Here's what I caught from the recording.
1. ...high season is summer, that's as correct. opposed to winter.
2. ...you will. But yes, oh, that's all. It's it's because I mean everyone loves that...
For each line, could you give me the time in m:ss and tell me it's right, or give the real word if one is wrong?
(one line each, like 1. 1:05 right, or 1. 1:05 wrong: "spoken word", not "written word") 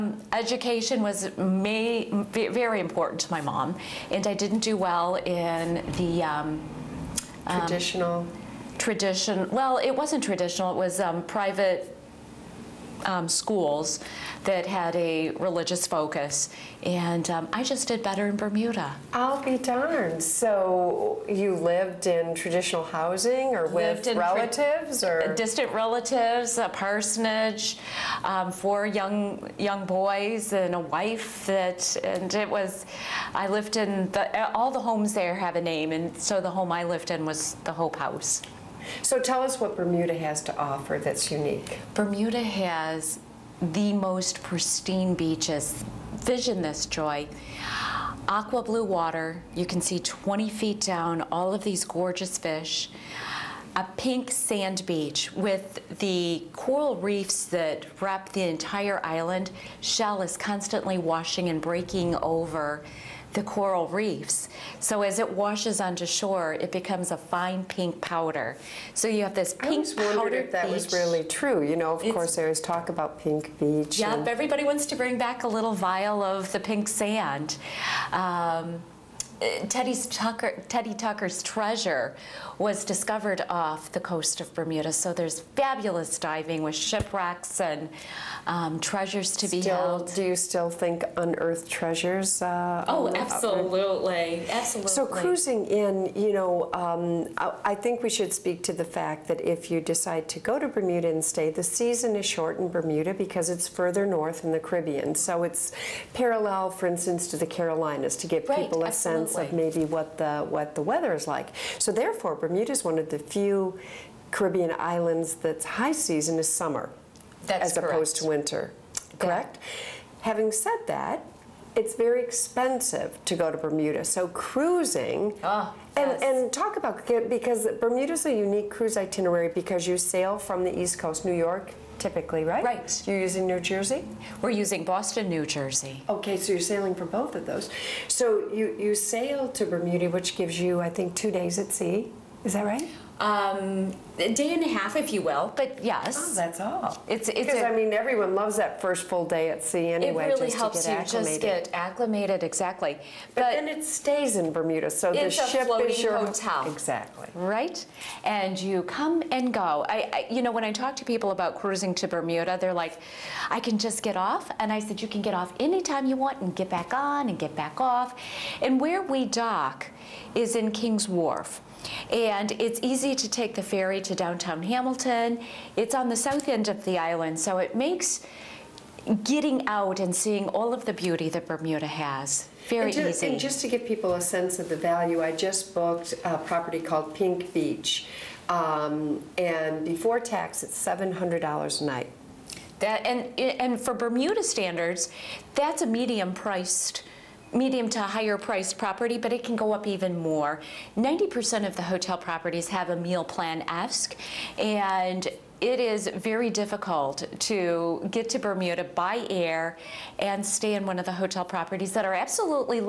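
1. 1:55 right
2. 2:25 right.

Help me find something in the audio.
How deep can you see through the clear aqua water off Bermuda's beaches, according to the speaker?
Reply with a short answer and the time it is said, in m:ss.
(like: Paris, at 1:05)
20 feet, at 0:50.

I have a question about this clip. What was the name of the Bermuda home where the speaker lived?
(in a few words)
Hope House.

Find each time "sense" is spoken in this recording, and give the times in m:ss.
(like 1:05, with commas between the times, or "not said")
1:49, 3:04.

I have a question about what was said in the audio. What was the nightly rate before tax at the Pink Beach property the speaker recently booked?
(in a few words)
$700.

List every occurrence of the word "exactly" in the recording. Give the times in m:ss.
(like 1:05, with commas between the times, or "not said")
2:32, 2:36.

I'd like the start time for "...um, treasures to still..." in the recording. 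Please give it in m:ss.
1:28.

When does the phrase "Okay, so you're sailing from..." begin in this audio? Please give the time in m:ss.
2:16.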